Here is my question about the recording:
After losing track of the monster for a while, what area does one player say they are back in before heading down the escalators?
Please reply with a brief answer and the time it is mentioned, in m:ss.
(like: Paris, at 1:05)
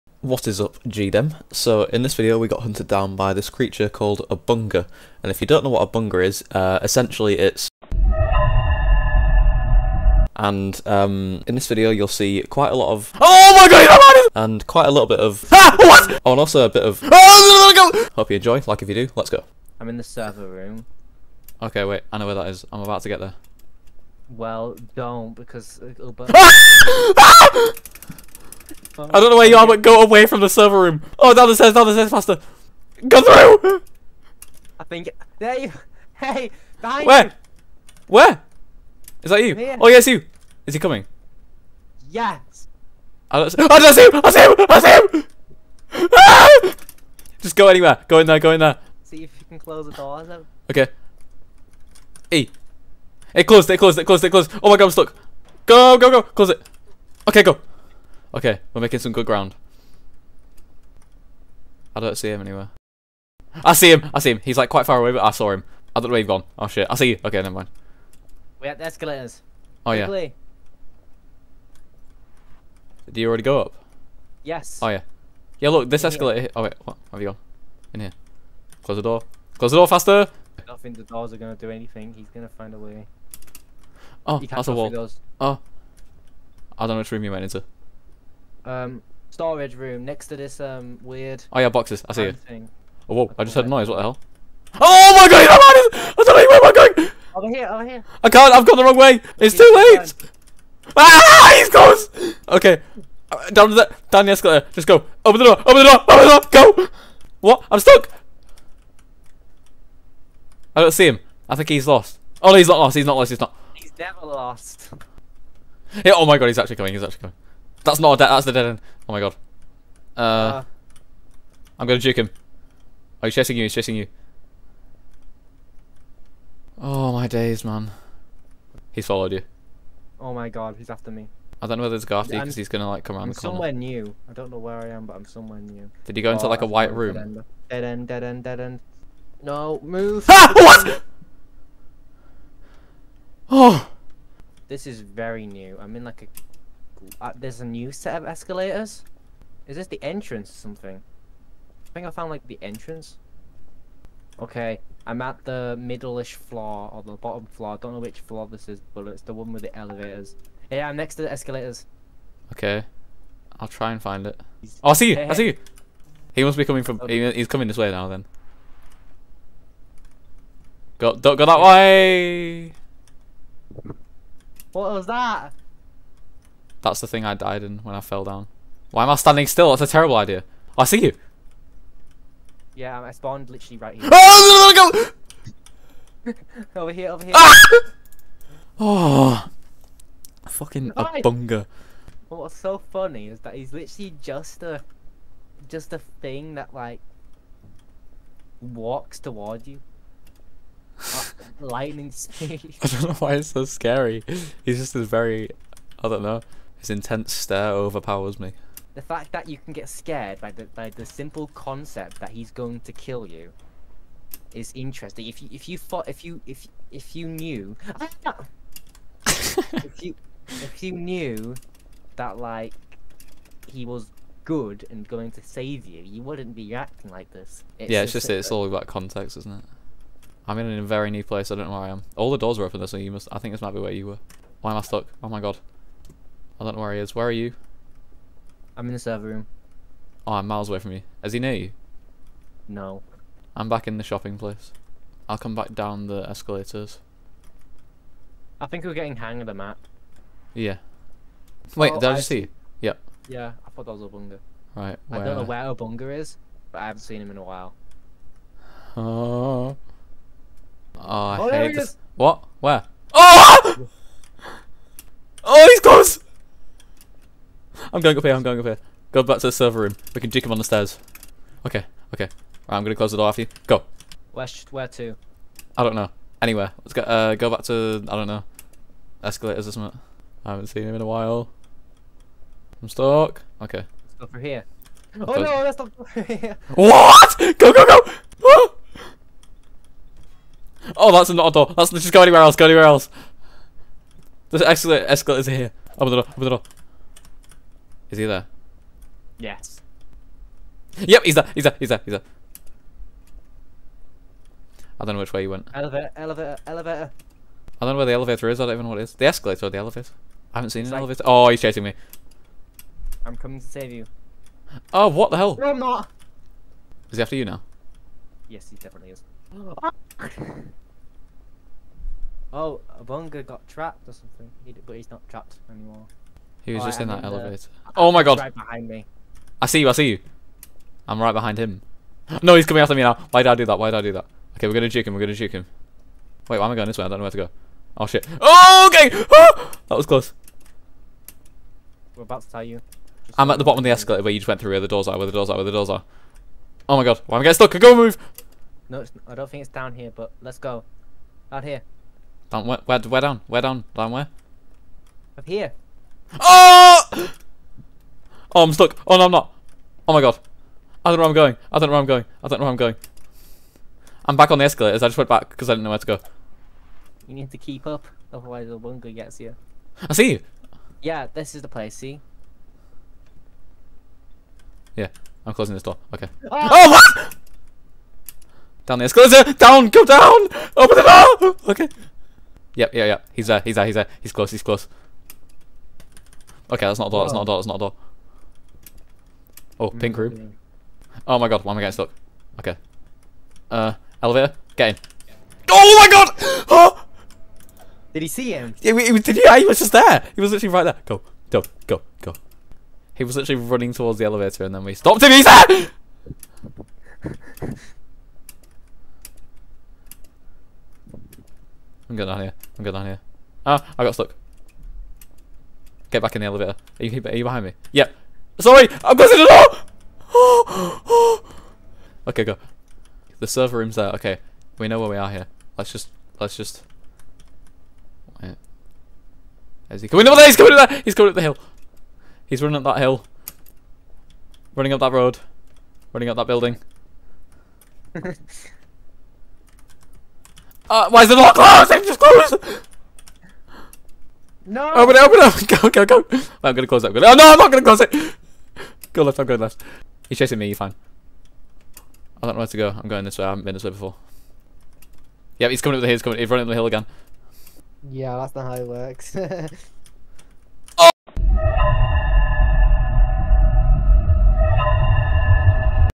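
the shopping place, at 4:04.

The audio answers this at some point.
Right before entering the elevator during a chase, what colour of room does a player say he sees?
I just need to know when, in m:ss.
6:29.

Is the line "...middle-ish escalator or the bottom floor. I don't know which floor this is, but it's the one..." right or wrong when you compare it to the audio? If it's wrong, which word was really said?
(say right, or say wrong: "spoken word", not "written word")
wrong: "floor", not "escalator".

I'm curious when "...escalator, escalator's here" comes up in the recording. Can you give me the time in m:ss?
4:54.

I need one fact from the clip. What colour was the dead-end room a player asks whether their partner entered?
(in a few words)
white.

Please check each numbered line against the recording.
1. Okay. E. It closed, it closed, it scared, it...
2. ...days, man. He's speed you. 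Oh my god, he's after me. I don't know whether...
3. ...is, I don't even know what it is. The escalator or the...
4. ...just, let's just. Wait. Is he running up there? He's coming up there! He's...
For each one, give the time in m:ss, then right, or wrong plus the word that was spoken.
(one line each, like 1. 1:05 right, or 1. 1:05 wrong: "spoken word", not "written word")
1. 0:50 wrong: "closed", not "scared"
2. 2:07 wrong: "followed", not "speed"
3. 5:08 right
4. 7:05 wrong: "coming", not "running".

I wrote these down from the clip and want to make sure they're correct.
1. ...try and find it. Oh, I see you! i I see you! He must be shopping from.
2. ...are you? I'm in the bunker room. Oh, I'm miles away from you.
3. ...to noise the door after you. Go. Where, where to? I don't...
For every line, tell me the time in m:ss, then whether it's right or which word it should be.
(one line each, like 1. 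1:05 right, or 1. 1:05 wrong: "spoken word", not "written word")
1. 2:43 wrong: "coming", not "shopping"
2. 3:57 wrong: "server", not "bunker"
3. 4:32 wrong: "close", not "noise".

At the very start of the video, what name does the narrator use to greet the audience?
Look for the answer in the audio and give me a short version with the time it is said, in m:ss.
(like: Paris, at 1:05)
GDEM, at 0:00.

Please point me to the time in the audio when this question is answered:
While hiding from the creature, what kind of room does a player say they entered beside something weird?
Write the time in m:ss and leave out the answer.
1:29.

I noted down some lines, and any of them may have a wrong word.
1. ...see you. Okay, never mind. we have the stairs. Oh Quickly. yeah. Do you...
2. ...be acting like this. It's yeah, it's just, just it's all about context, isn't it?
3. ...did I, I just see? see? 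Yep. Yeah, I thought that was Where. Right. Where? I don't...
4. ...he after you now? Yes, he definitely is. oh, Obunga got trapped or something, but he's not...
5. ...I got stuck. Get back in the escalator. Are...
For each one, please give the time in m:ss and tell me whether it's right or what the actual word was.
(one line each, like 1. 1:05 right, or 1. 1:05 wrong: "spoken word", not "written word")
1. 1:06 wrong: "escalators", not "stairs"
2. 3:46 right
3. 4:11 wrong: "Obunga", not "Where"
4. 5:17 right
5. 6:53 wrong: "elevator", not "escalator".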